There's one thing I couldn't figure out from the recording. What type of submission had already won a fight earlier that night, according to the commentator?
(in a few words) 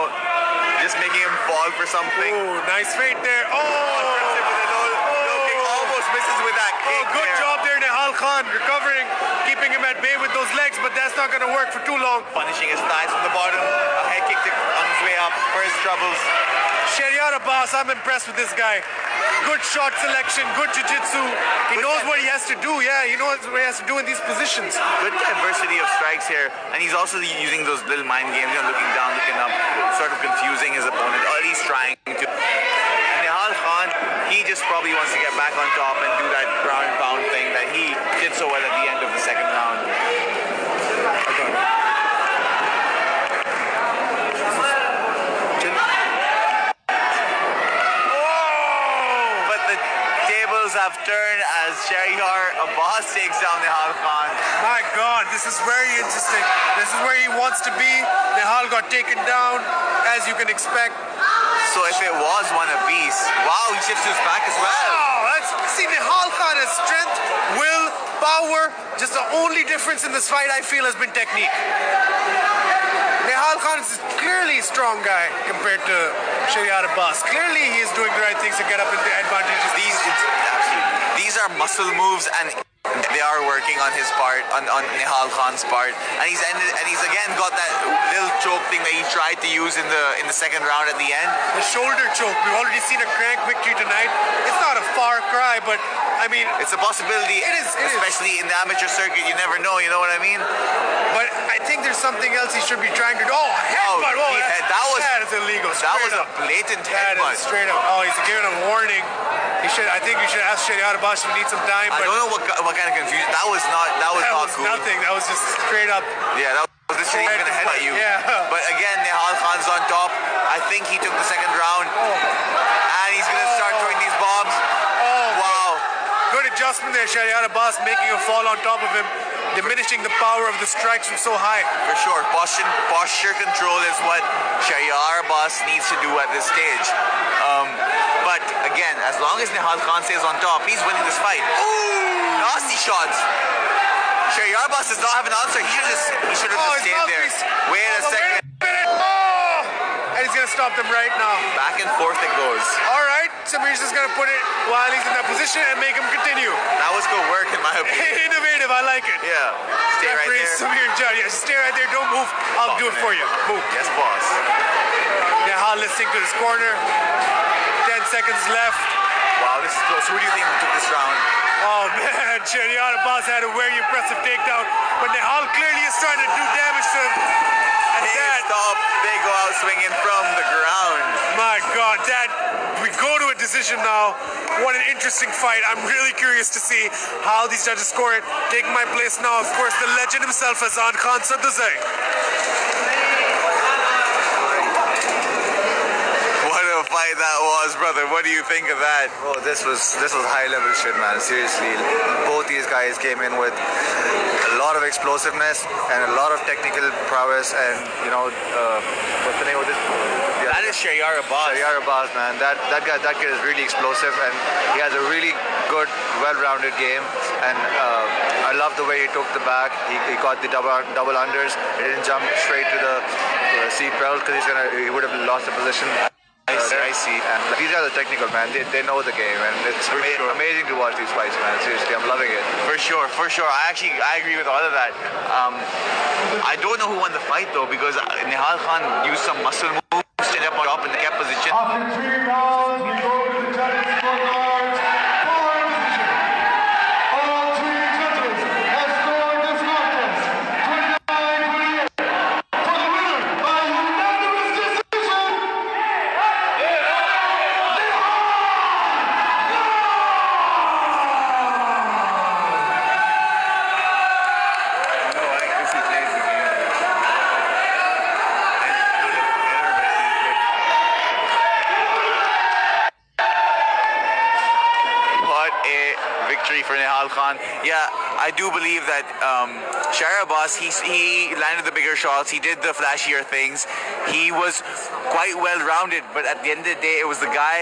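Crank.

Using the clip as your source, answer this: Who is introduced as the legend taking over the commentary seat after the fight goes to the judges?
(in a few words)
Azan Khan Sadduzai.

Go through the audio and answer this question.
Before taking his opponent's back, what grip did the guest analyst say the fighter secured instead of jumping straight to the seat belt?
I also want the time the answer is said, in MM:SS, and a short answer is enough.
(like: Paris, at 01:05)
Double unders, at 03:40.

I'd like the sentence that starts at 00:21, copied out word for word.
He good knows what he has to do, yeah, he knows what he has to do in these positions.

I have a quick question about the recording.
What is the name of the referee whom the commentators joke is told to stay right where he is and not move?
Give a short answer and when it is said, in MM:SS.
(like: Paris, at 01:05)
Samir Jat, at 02:40.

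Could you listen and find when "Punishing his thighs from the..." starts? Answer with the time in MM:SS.
00:12.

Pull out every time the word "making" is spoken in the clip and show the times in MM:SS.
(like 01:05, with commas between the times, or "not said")
00:00, 02:07.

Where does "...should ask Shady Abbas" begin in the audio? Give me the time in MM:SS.
01:50.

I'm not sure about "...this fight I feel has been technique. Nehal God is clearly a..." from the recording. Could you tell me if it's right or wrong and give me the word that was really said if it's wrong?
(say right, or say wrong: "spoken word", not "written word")
wrong: "Khan", not "God".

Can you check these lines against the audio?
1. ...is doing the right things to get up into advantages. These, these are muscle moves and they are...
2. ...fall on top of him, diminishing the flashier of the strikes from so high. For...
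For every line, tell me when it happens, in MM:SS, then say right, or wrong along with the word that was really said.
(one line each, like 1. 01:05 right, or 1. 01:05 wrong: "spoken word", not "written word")
1. 01:17 right
2. 02:08 wrong: "power", not "flashier".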